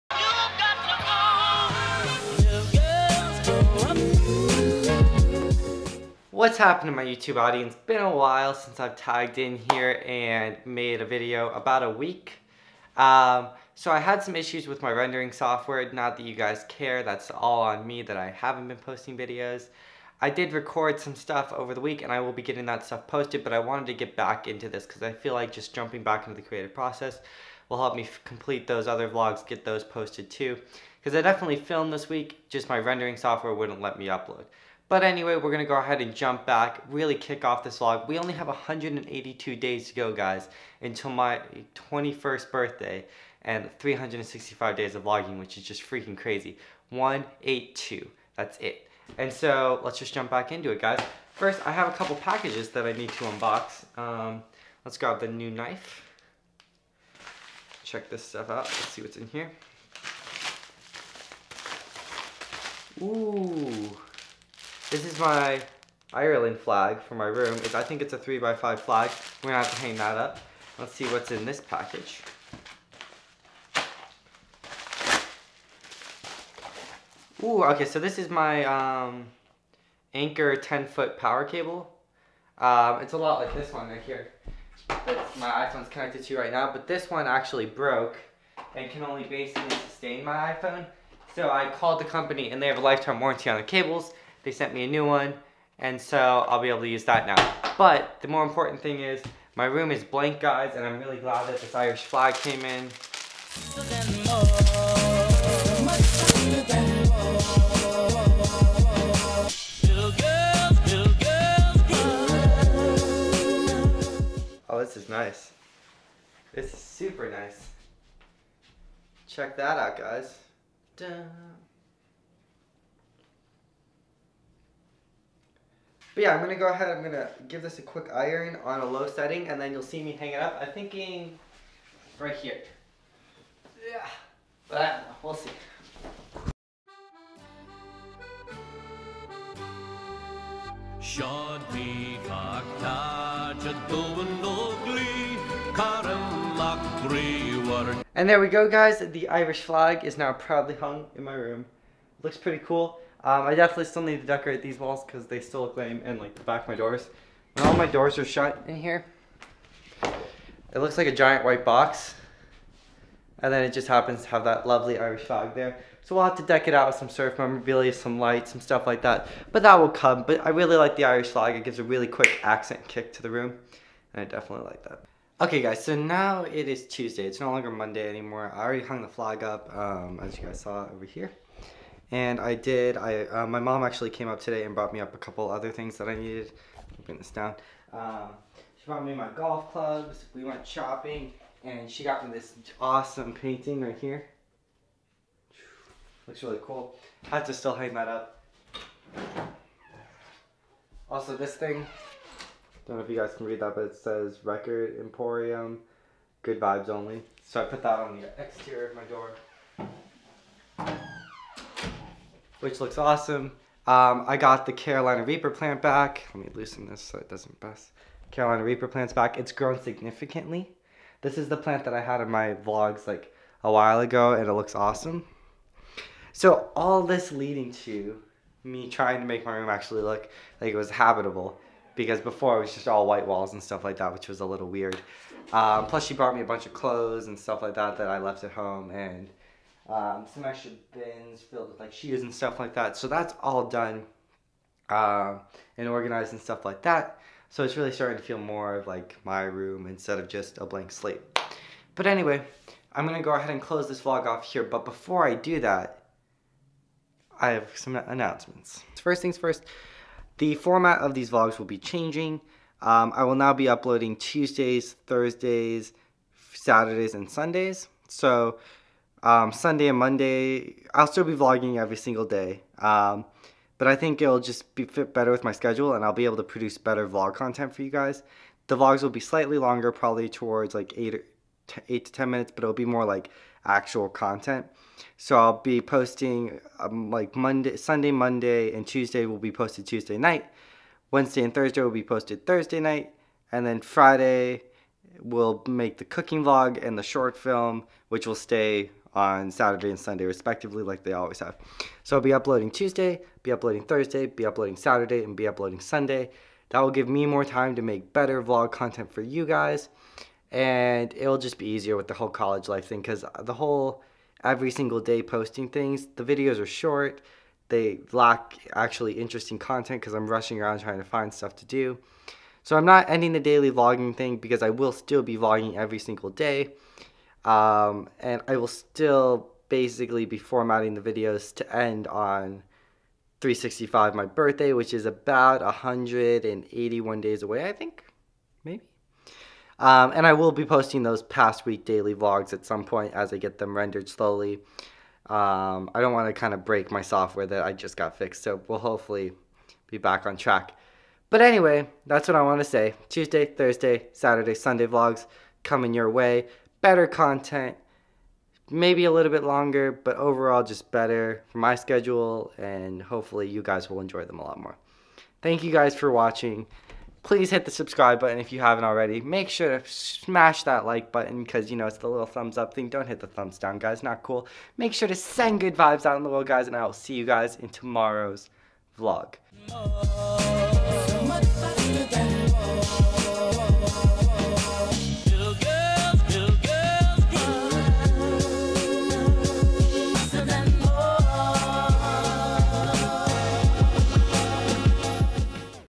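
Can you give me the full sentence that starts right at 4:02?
So that's all done uh, and organized and stuff like that.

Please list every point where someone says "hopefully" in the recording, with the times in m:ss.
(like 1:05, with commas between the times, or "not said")
5:48, 6:03.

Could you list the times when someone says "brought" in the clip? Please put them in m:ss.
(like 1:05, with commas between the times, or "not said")
3:04, 3:08, 3:56.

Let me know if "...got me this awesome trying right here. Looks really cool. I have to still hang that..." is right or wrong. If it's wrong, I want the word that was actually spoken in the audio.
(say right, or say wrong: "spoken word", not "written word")
wrong: "painting", not "trying".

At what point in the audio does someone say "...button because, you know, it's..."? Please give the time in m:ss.
6:11.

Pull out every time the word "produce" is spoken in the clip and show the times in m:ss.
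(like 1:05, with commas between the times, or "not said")
4:36.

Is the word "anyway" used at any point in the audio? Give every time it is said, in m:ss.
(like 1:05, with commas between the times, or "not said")
0:35, 4:12, 5:51.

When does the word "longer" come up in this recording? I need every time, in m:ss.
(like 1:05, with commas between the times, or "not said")
2:57, 4:39, 5:59.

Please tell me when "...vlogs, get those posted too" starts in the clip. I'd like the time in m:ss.
0:29.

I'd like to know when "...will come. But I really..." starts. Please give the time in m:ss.
2:49.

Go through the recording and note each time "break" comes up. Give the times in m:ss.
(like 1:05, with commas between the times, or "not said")
5:46.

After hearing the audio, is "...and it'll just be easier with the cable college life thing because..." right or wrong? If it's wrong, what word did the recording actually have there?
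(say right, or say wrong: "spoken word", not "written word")
wrong: "whole", not "cable".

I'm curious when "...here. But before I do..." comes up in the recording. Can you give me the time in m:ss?
4:14.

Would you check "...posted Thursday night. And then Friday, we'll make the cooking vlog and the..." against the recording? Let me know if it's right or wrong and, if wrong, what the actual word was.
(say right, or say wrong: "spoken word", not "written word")
right.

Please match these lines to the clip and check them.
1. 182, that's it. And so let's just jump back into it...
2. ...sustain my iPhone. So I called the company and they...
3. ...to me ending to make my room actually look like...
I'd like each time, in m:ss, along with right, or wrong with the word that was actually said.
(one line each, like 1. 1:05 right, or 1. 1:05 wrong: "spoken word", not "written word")
1. 0:46 right
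2. 1:29 right
3. 3:47 wrong: "trying", not "ending".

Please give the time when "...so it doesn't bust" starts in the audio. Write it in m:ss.
3:37.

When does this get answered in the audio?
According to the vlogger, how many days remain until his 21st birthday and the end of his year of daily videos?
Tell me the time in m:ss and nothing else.
0:38.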